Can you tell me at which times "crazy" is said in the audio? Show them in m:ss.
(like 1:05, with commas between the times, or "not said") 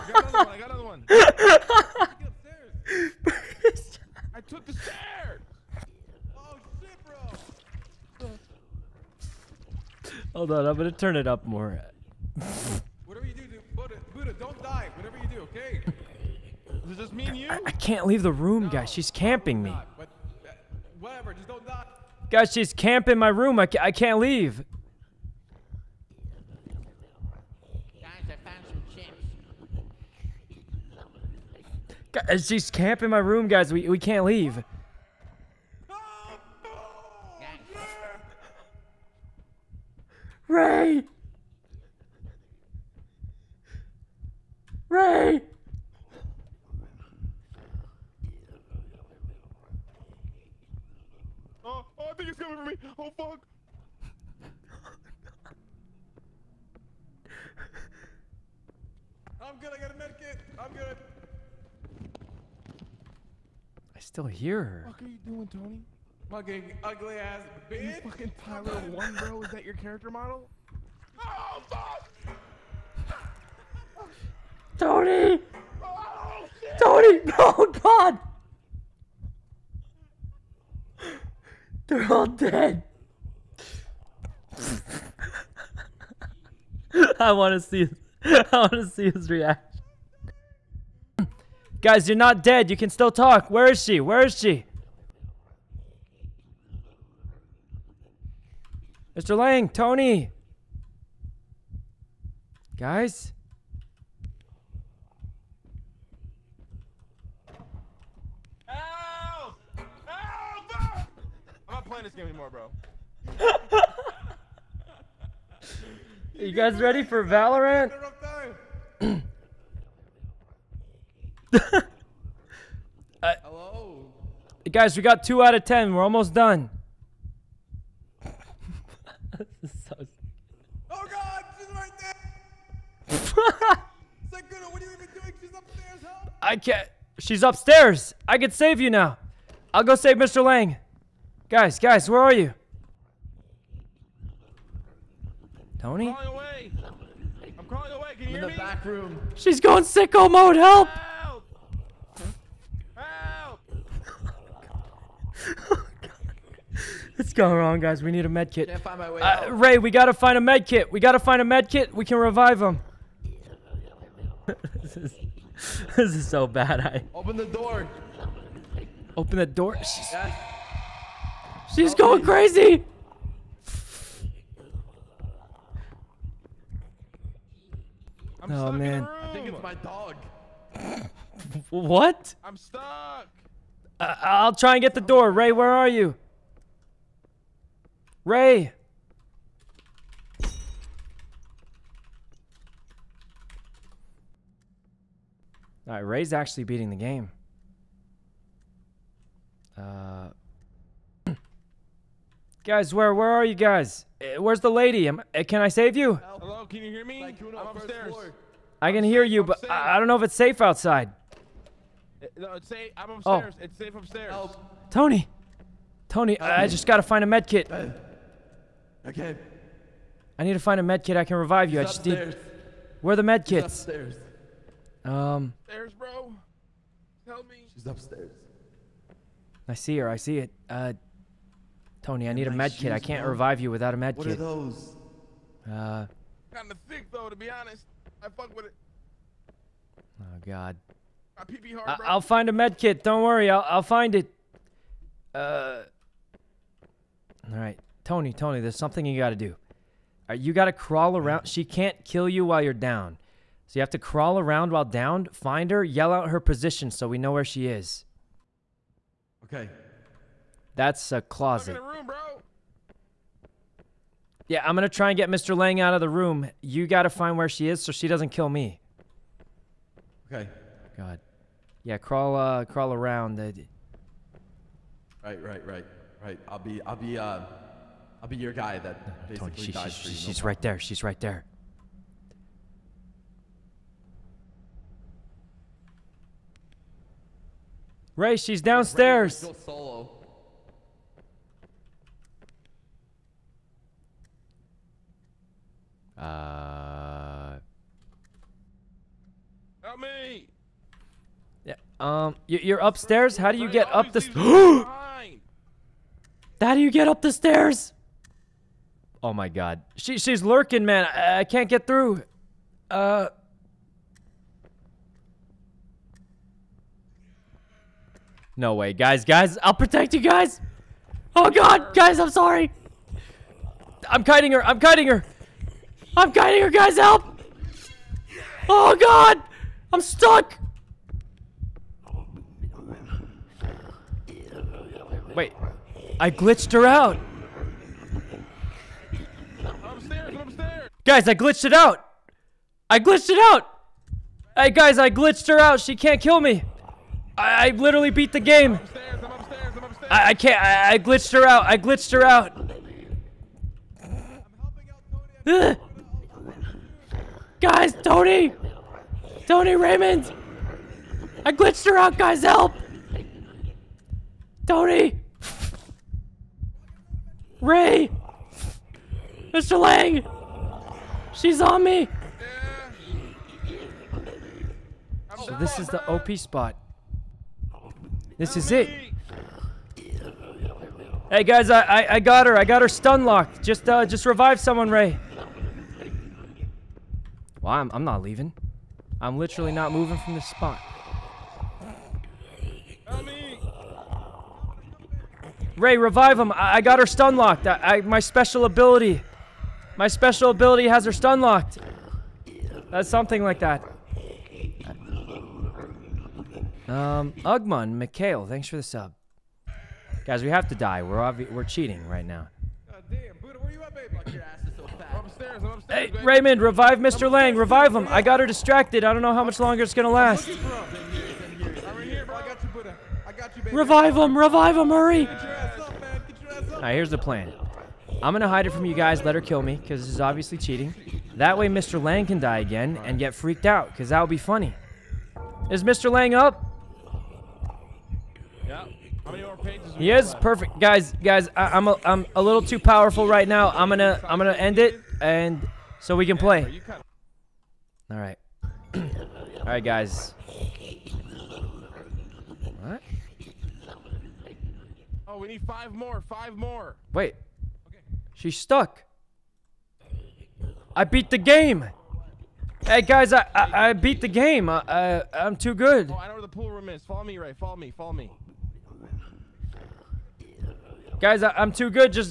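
2:52.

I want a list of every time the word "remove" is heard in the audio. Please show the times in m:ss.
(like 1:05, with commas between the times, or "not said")
not said.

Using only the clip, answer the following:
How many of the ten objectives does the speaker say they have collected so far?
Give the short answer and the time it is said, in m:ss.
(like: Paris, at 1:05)
2, at 2:05.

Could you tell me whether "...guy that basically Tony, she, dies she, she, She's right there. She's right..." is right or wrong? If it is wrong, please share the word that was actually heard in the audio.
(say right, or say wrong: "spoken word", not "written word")
right.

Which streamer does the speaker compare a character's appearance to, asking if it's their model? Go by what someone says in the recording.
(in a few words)
Tyler One.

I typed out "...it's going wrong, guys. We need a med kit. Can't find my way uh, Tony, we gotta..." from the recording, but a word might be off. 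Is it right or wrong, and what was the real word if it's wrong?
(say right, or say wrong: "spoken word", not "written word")
wrong: "Ray", not "Tony".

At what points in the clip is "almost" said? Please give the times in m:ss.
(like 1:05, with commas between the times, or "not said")
2:06.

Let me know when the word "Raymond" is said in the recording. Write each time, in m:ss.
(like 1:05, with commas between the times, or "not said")
5:59, 6:56.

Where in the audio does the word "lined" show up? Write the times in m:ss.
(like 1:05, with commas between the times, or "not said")
not said.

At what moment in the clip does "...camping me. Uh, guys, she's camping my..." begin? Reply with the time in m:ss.
0:19.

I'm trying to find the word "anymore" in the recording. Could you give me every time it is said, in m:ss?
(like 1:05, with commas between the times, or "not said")
1:52.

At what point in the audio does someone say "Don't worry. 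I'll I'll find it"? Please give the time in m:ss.
4:03.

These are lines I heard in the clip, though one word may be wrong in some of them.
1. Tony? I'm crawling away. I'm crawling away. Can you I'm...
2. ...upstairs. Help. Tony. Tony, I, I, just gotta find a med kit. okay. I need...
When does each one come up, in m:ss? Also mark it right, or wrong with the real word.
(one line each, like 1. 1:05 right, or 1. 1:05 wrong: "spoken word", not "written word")
1. 2:25 right
2. 3:33 right.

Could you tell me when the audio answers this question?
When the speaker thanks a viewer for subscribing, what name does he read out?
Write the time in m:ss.
6:47.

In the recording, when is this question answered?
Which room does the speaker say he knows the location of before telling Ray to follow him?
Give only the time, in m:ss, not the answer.
7:46.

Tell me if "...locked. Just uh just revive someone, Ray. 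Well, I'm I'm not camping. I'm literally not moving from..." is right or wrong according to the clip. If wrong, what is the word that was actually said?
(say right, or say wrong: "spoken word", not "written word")
wrong: "leaving", not "camping".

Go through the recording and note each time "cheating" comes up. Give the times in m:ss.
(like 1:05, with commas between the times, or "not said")
6:51, 7:10.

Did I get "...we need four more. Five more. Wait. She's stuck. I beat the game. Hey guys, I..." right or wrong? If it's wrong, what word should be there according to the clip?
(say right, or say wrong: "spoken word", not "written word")
wrong: "five", not "four".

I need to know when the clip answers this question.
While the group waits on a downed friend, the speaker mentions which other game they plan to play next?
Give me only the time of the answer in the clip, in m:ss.
1:57.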